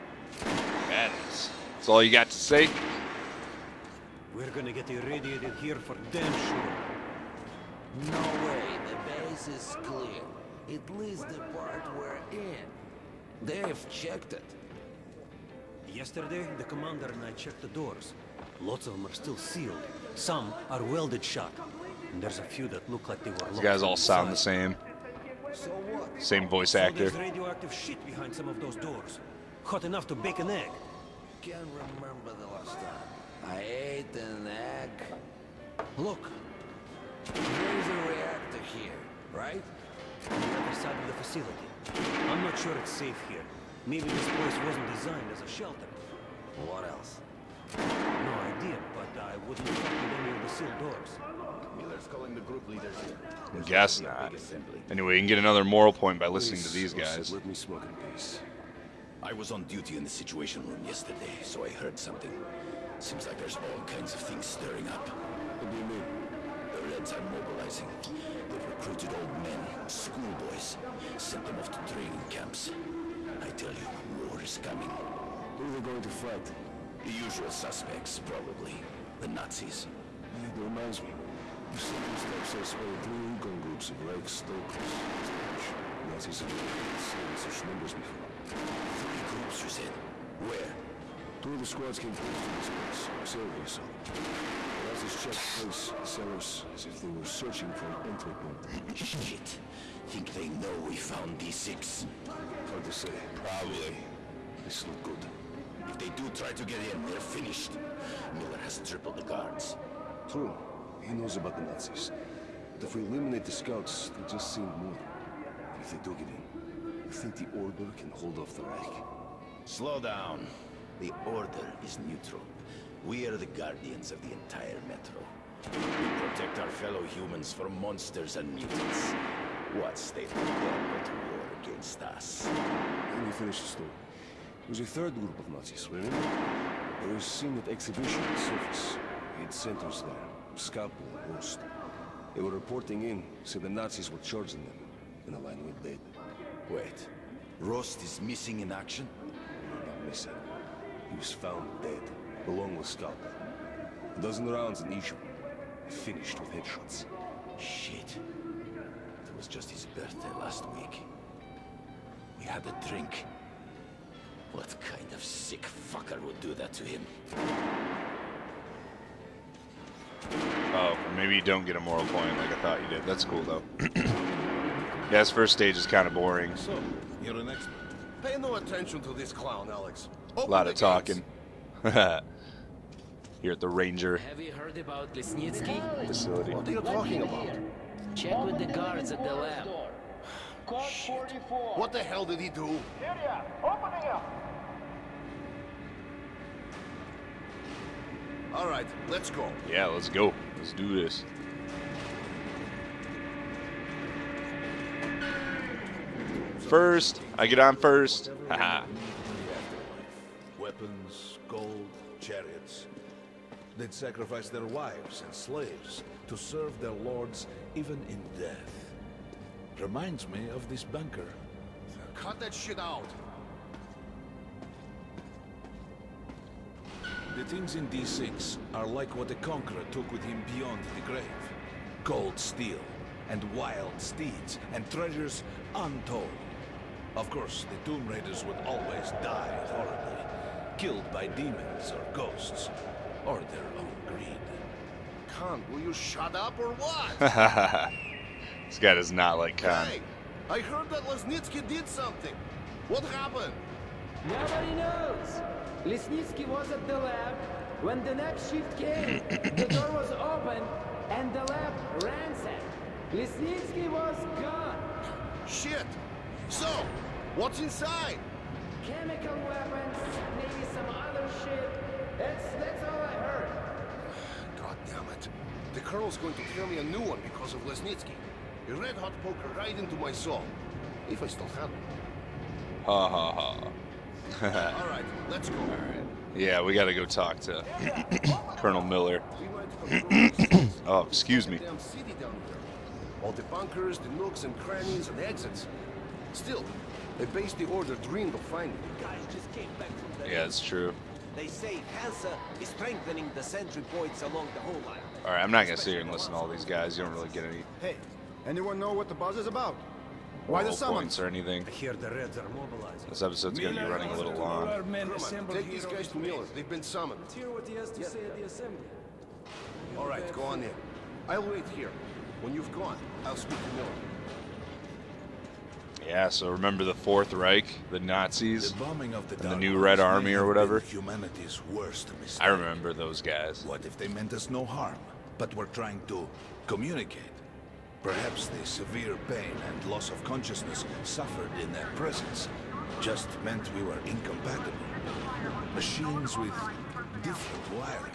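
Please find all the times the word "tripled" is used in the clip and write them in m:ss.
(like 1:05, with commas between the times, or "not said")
1:48.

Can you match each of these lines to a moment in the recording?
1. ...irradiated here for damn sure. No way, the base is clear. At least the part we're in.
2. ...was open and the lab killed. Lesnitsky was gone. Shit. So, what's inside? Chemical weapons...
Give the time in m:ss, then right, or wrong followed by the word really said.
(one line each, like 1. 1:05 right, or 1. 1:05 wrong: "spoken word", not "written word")
1. 0:04 right
2. 4:19 wrong: "ransacked", not "killed".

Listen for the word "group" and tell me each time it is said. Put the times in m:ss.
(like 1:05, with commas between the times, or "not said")
0:52, 1:23, 1:29, 2:15.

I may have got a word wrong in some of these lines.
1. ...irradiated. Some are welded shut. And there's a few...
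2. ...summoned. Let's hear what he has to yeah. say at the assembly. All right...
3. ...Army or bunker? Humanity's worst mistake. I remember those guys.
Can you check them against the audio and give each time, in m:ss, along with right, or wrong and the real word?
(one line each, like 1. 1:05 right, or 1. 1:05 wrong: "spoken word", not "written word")
1. 0:19 wrong: "sealed", not "irradiated"
2. 5:16 right
3. 5:29 wrong: "whatever", not "bunker".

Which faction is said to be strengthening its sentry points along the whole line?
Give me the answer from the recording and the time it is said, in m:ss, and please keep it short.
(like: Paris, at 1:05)
Hansa, at 5:02.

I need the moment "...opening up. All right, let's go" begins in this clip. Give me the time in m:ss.
3:13.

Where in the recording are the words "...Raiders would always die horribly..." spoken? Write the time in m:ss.
3:58.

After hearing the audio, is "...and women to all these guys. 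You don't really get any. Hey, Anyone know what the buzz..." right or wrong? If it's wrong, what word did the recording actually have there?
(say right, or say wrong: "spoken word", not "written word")
wrong: "listen", not "women".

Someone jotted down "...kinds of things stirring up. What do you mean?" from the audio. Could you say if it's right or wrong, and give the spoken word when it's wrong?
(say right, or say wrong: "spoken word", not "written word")
right.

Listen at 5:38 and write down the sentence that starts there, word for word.
Perhaps the severe pain and loss of consciousness suffered in their presence just meant we were incompatible.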